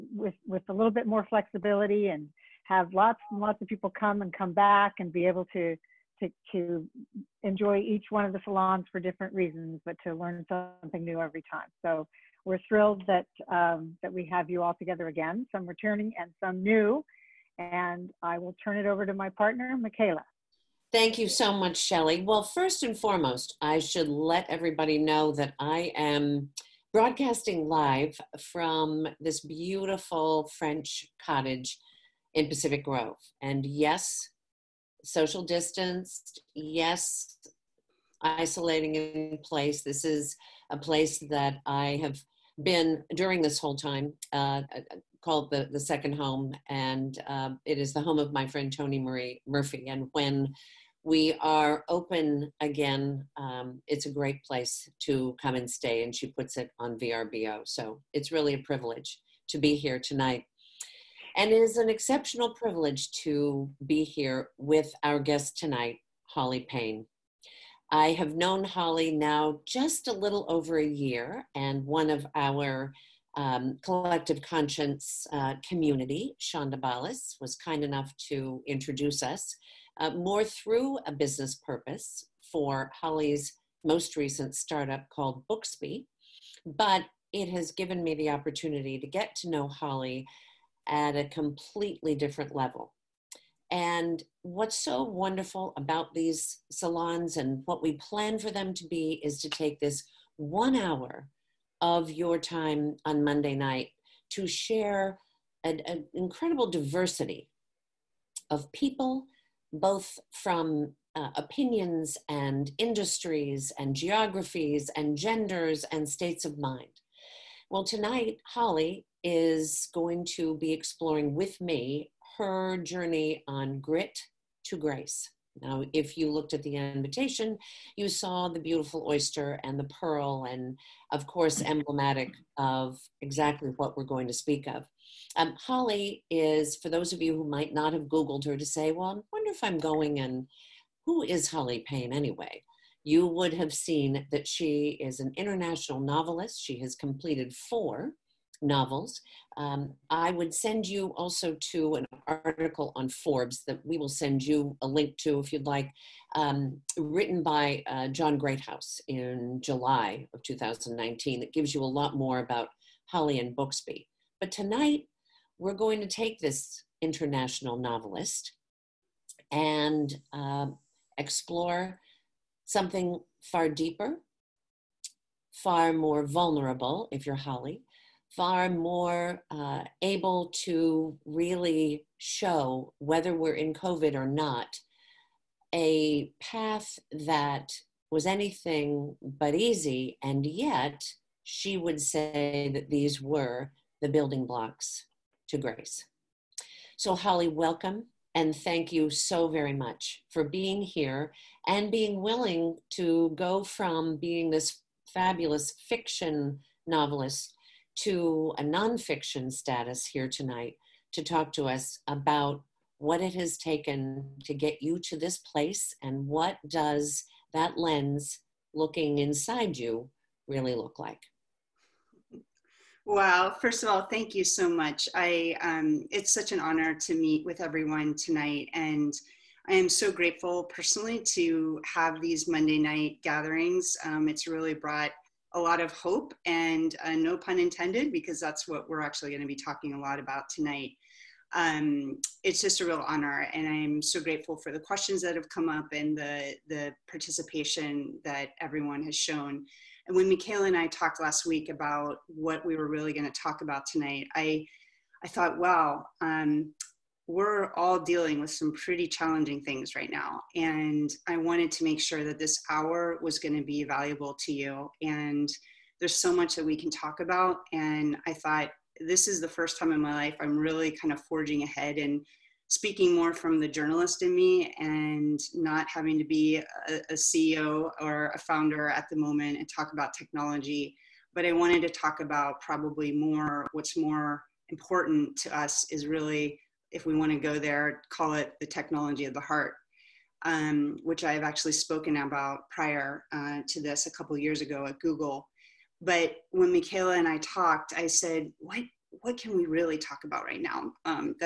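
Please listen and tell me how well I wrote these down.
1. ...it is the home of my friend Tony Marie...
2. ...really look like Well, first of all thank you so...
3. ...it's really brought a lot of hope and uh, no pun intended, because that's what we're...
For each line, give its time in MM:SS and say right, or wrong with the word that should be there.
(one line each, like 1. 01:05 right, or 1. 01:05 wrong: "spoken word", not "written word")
1. 00:47 right
2. 03:40 right
3. 03:54 right.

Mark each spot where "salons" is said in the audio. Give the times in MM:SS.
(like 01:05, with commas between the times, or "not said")
00:08, 01:36.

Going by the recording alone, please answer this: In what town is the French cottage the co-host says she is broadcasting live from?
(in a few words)
Pacific Grove.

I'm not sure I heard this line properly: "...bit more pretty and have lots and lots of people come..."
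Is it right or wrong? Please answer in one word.
wrong.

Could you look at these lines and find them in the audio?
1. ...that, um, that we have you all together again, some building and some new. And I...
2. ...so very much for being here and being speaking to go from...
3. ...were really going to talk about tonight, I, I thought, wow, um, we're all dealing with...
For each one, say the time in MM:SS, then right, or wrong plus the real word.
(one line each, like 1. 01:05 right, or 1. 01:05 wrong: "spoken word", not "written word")
1. 00:13 wrong: "returning", not "building"
2. 03:19 wrong: "willing", not "speaking"
3. 04:12 right.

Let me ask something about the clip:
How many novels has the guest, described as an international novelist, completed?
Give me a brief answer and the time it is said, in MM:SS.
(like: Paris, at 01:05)
4, at 02:27.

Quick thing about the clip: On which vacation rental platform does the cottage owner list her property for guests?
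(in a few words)
VRBO.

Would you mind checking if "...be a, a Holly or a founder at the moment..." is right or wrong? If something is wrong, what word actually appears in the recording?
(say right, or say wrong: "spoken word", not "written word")
wrong: "CEO", not "Holly".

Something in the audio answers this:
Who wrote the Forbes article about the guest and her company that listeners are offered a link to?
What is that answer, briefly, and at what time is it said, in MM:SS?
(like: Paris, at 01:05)
John Greathouse, at 02:38.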